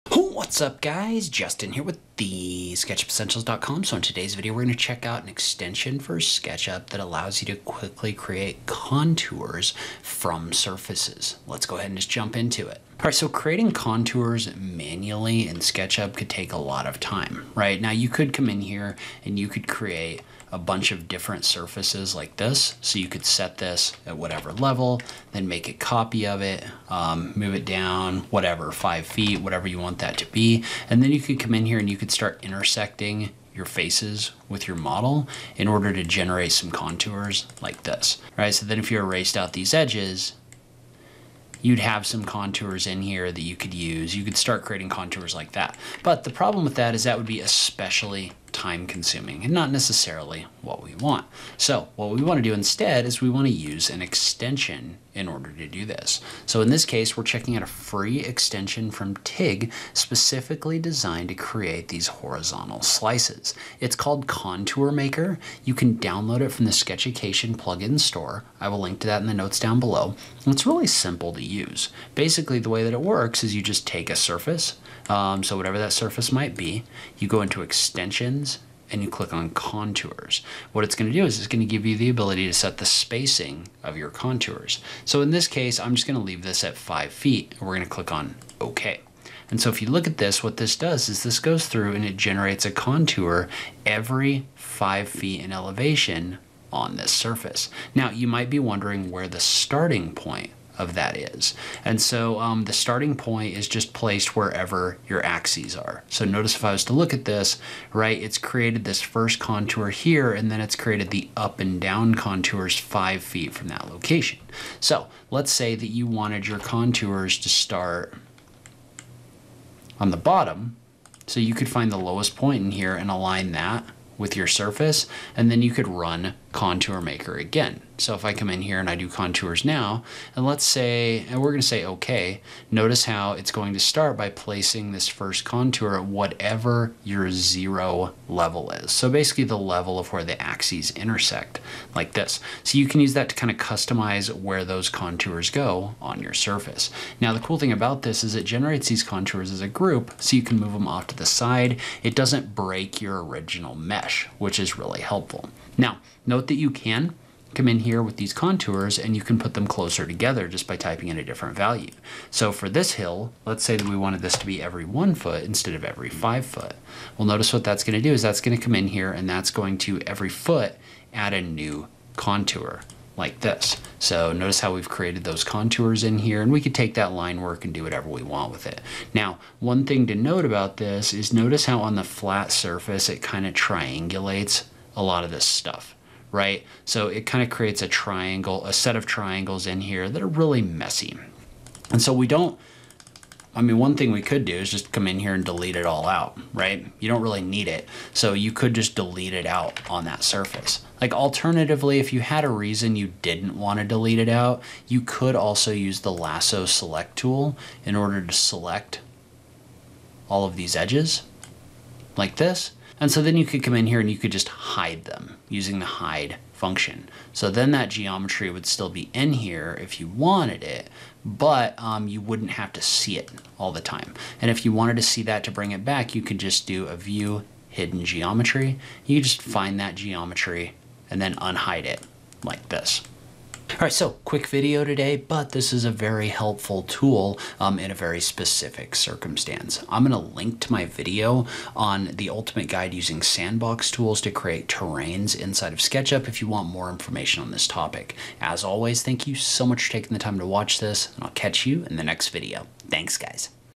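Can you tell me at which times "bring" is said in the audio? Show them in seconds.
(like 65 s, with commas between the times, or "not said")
225 s.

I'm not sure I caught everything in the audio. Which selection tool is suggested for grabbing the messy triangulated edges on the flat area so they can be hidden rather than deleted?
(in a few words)
lasso select tool.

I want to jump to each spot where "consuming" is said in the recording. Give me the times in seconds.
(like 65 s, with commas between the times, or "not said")
48 s.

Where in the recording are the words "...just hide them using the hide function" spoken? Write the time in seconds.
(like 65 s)
214 s.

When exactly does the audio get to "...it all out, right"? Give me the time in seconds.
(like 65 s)
195 s.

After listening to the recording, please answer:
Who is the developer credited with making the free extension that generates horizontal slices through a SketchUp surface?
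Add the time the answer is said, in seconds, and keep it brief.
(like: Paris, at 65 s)
TIG, at 59 s.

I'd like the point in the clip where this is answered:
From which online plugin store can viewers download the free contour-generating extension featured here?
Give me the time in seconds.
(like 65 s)
66 s.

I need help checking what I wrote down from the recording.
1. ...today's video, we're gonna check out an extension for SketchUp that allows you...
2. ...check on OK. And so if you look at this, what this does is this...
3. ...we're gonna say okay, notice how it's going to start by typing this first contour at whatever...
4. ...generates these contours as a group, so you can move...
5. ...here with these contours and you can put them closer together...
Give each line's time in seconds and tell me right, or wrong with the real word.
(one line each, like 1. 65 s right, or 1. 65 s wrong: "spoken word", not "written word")
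1. 4 s right
2. 87 s wrong: "click", not "check"
3. 131 s wrong: "placing", not "typing"
4. 148 s right
5. 157 s right.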